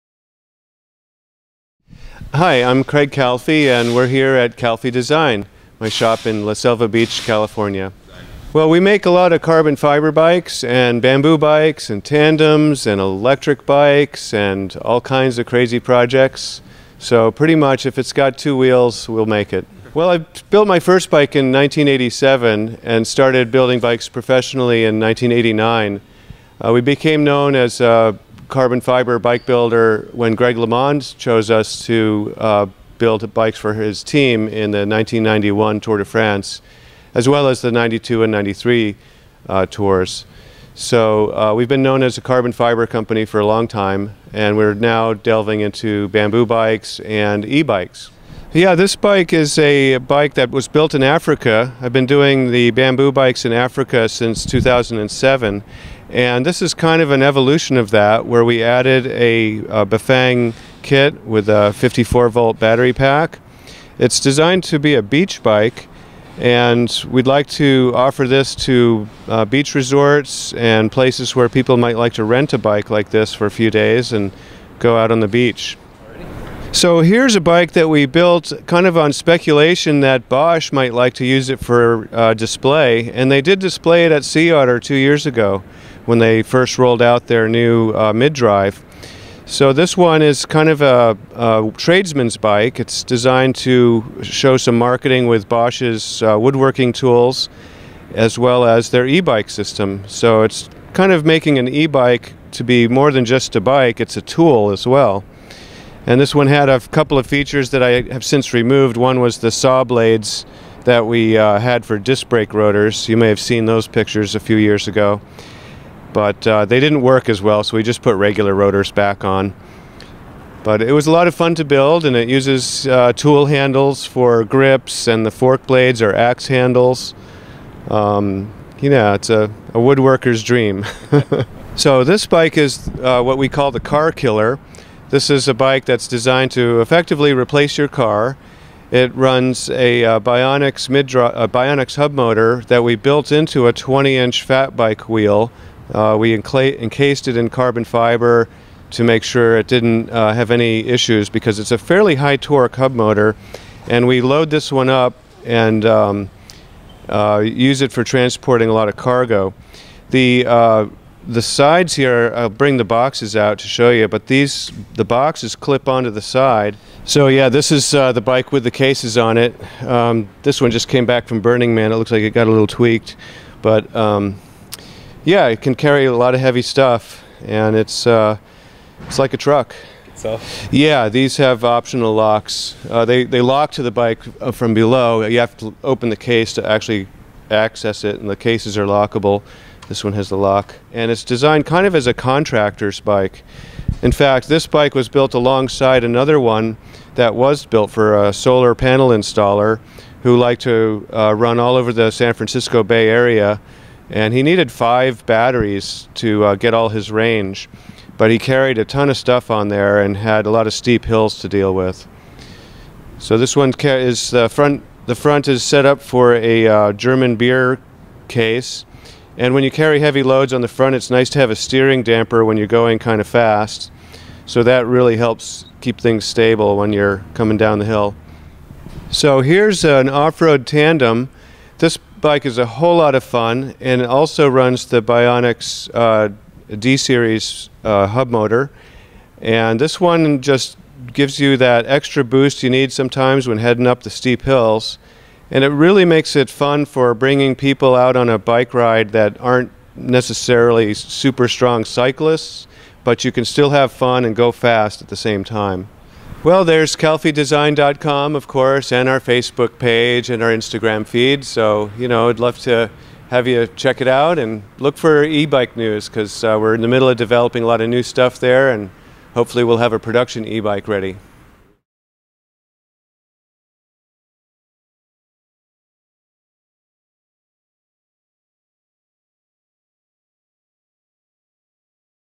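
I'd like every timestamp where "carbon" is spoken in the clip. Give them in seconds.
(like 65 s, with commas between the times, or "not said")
9 s, 28 s, 42 s, 147 s.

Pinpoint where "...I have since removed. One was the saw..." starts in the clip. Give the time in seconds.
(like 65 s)
107 s.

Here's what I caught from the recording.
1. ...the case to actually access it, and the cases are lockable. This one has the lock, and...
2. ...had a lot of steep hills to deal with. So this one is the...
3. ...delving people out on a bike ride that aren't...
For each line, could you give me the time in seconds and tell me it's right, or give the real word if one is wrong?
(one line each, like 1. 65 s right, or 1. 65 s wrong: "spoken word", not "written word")
1. 186 s right
2. 210 s right
3. 247 s wrong: "bringing", not "delving".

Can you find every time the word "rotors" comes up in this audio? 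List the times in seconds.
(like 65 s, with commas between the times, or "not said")
112 s, 118 s.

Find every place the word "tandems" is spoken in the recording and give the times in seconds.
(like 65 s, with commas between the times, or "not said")
12 s, 230 s.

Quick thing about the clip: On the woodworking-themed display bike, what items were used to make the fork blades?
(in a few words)
axe handles.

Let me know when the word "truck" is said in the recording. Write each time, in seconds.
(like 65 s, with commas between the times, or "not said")
179 s.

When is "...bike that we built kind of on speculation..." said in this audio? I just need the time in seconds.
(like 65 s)
77 s.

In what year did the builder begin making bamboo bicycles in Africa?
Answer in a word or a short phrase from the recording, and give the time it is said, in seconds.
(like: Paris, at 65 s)
2007, at 54 s.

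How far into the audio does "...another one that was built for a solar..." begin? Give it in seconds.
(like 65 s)
196 s.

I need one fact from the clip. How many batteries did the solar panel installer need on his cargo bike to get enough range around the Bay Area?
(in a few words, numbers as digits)
5.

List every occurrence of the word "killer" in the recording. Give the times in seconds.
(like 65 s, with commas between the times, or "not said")
134 s.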